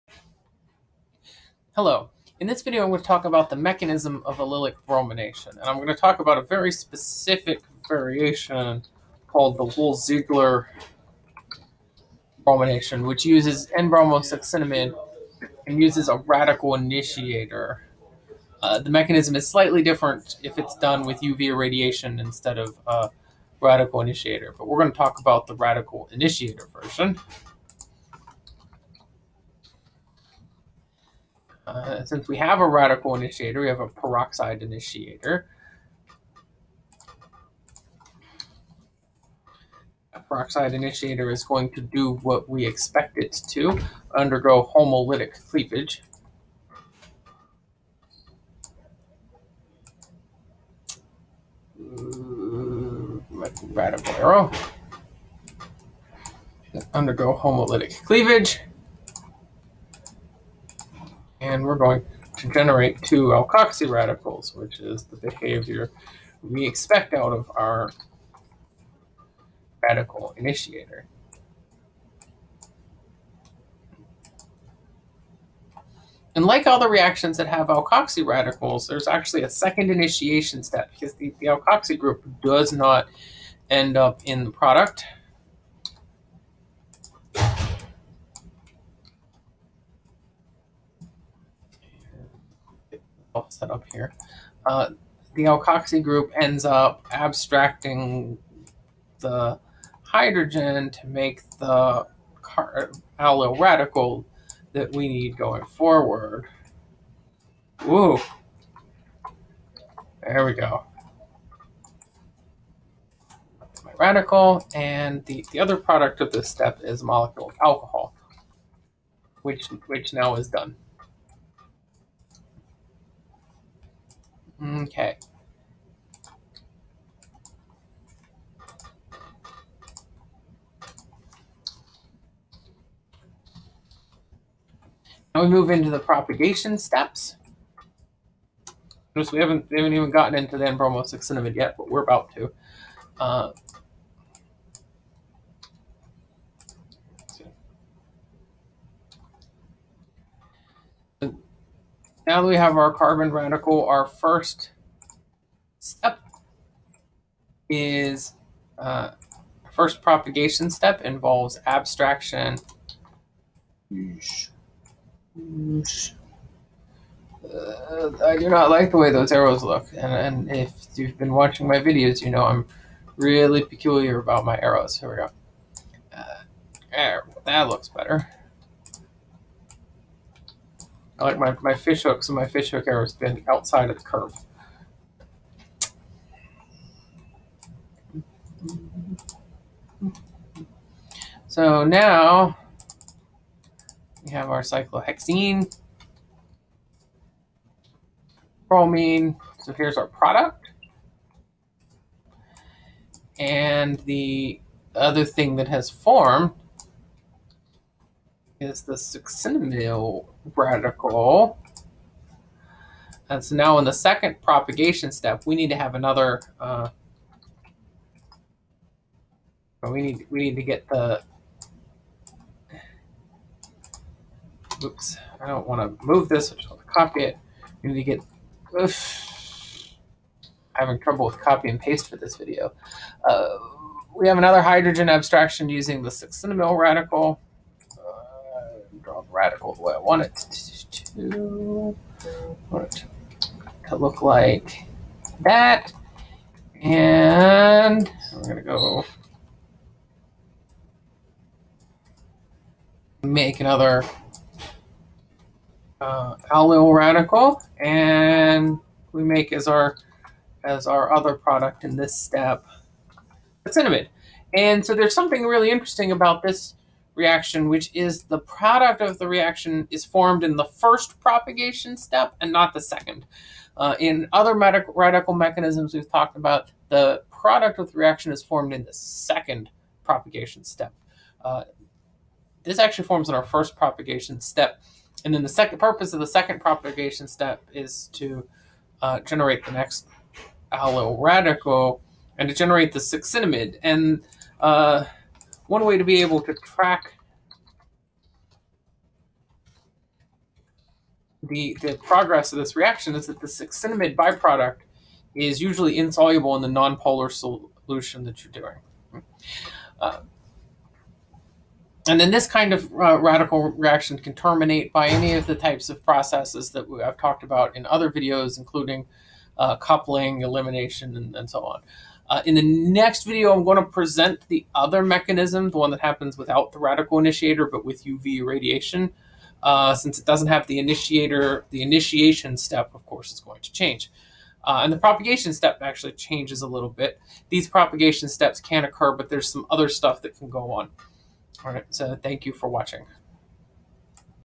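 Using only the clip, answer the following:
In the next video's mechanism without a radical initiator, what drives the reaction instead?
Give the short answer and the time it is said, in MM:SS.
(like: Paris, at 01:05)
UV radiation, at 05:28.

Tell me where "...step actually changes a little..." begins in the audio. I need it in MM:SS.
05:35.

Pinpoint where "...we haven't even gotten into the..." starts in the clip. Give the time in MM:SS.
02:19.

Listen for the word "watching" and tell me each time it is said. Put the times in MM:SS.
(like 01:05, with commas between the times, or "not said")
02:51, 05:42.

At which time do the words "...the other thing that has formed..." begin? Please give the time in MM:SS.
03:24.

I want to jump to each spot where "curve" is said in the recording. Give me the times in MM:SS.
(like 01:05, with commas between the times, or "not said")
03:04.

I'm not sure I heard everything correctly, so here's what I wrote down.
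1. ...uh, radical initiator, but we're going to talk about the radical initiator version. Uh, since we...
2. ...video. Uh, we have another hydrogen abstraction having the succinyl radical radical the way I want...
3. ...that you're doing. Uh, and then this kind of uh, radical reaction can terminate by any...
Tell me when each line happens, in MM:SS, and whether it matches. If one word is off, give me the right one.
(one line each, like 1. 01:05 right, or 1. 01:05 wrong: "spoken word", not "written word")
1. 00:22 right
2. 03:52 wrong: "using", not "having"
3. 05:08 right.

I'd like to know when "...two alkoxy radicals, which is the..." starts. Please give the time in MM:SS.
01:03.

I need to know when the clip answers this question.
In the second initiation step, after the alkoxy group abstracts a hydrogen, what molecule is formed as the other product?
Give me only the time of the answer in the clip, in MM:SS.
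01:57.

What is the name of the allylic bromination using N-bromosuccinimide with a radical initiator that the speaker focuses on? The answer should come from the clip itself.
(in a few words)
Wohl-Ziegler bromination.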